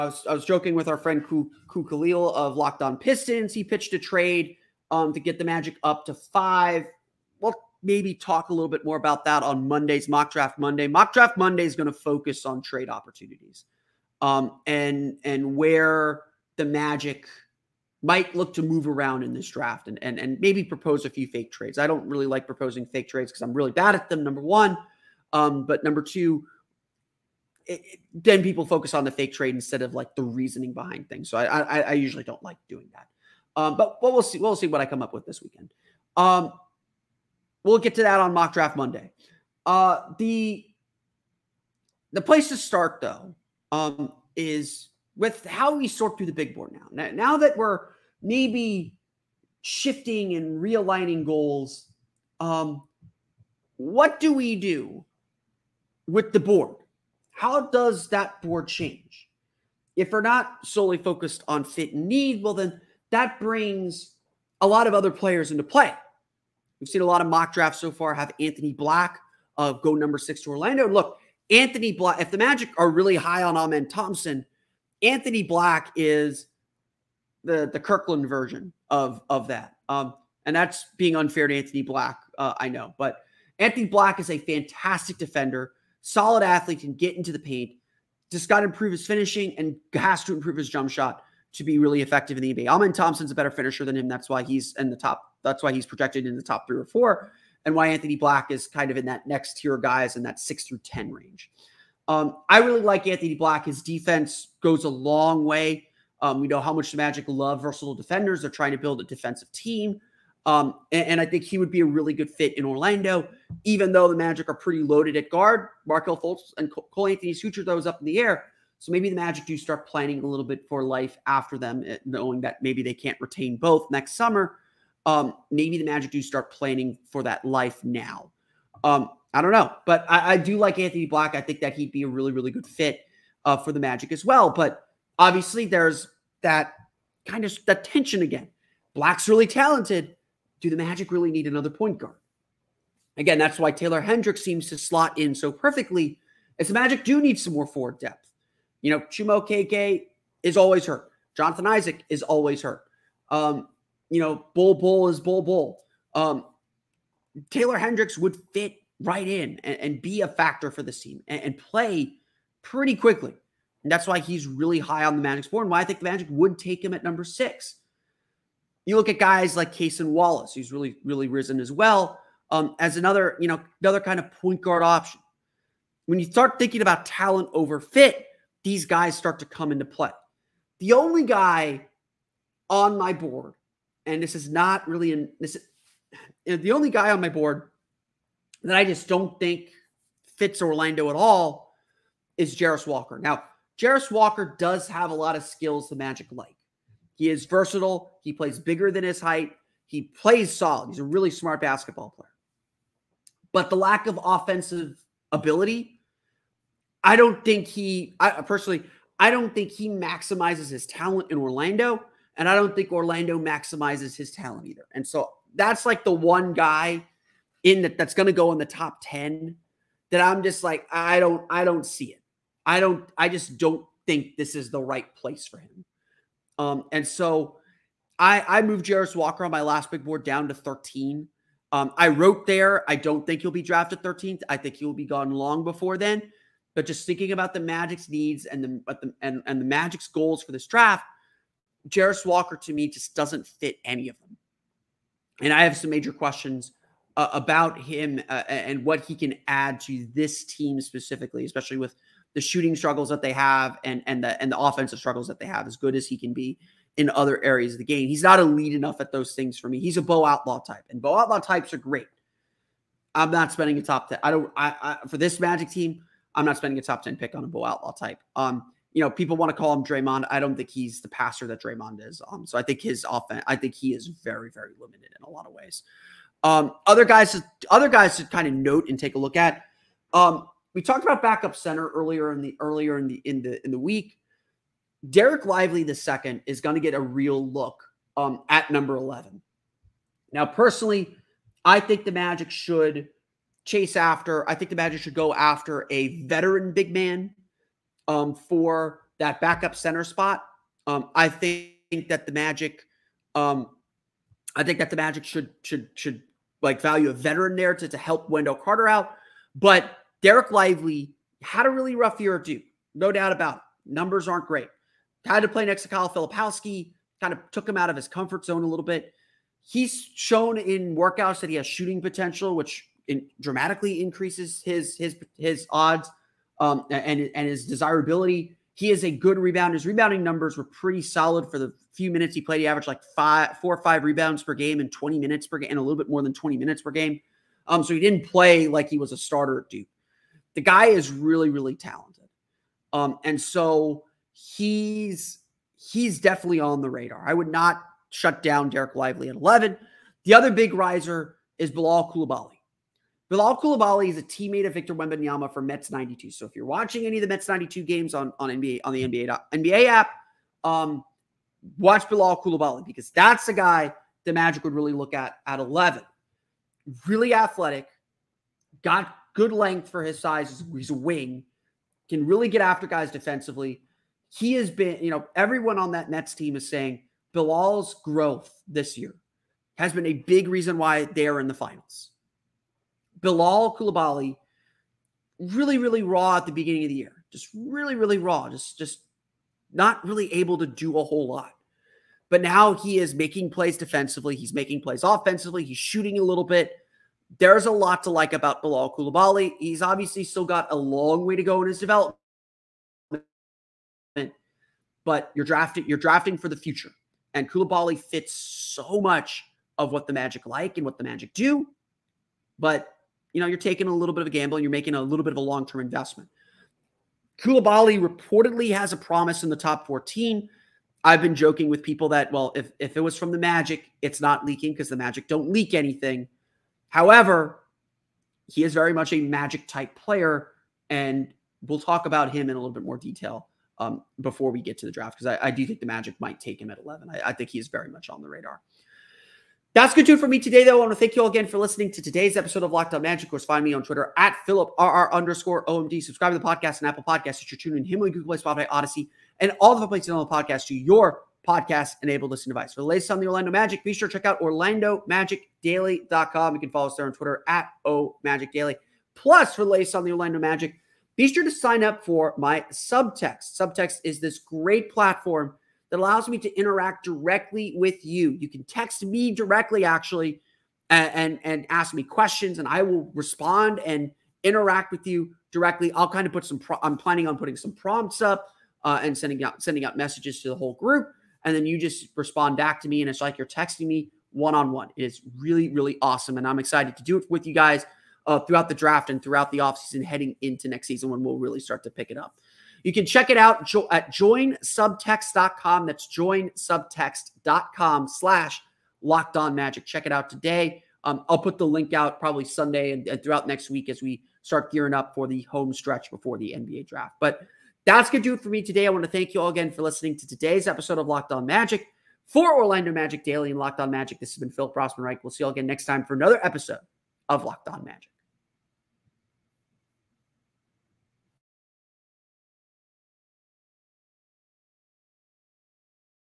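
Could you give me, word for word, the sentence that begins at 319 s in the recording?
He's shown in workouts that he has shooting potential, which in, dramatically increases his his his odds um, and and his desirability.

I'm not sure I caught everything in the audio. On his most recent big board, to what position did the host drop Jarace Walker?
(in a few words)
13.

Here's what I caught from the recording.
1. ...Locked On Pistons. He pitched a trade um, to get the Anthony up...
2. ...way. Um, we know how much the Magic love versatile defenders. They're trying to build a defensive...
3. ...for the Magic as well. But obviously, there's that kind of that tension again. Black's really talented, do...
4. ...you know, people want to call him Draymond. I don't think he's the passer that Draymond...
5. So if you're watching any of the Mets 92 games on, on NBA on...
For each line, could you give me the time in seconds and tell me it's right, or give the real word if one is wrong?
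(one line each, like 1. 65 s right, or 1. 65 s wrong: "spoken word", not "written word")
1. 2 s wrong: "Magic", not "Anthony"
2. 105 s right
3. 133 s right
4. 268 s right
5. 356 s right.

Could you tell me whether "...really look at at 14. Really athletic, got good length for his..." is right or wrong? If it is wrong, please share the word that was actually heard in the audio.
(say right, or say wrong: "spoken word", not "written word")
wrong: "11", not "14".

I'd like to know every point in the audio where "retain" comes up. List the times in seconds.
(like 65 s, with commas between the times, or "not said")
123 s.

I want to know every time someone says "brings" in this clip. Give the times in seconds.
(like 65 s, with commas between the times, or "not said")
63 s.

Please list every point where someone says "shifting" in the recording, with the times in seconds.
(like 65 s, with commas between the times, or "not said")
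49 s.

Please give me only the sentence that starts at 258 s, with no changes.
He's not elite enough at those things for me.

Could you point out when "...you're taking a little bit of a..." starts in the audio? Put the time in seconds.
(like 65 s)
413 s.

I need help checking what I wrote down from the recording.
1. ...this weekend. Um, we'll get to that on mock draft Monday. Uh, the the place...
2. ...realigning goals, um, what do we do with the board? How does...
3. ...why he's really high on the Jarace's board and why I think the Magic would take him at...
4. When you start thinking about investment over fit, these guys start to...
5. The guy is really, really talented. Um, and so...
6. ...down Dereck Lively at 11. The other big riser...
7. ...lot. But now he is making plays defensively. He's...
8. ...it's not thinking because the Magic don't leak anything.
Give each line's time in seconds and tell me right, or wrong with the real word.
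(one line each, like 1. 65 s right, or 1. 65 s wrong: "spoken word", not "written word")
1. 35 s right
2. 50 s right
3. 164 s wrong: "Magic", not "Jarace"
4. 176 s wrong: "talent", not "investment"
5. 340 s right
6. 348 s right
7. 391 s right
8. 424 s wrong: "leaking", not "thinking".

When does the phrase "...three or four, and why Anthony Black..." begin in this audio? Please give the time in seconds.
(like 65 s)
96 s.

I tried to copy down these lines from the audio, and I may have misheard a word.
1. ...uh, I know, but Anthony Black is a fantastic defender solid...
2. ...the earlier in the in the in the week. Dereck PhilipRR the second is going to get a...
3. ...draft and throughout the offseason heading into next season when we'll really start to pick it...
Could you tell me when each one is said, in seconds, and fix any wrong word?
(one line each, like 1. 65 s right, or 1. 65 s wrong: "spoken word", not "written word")
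1. 82 s right
2. 282 s wrong: "Lively", not "PhilipRR"
3. 488 s right.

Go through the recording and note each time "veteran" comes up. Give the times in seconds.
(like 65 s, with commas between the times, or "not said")
296 s, 307 s.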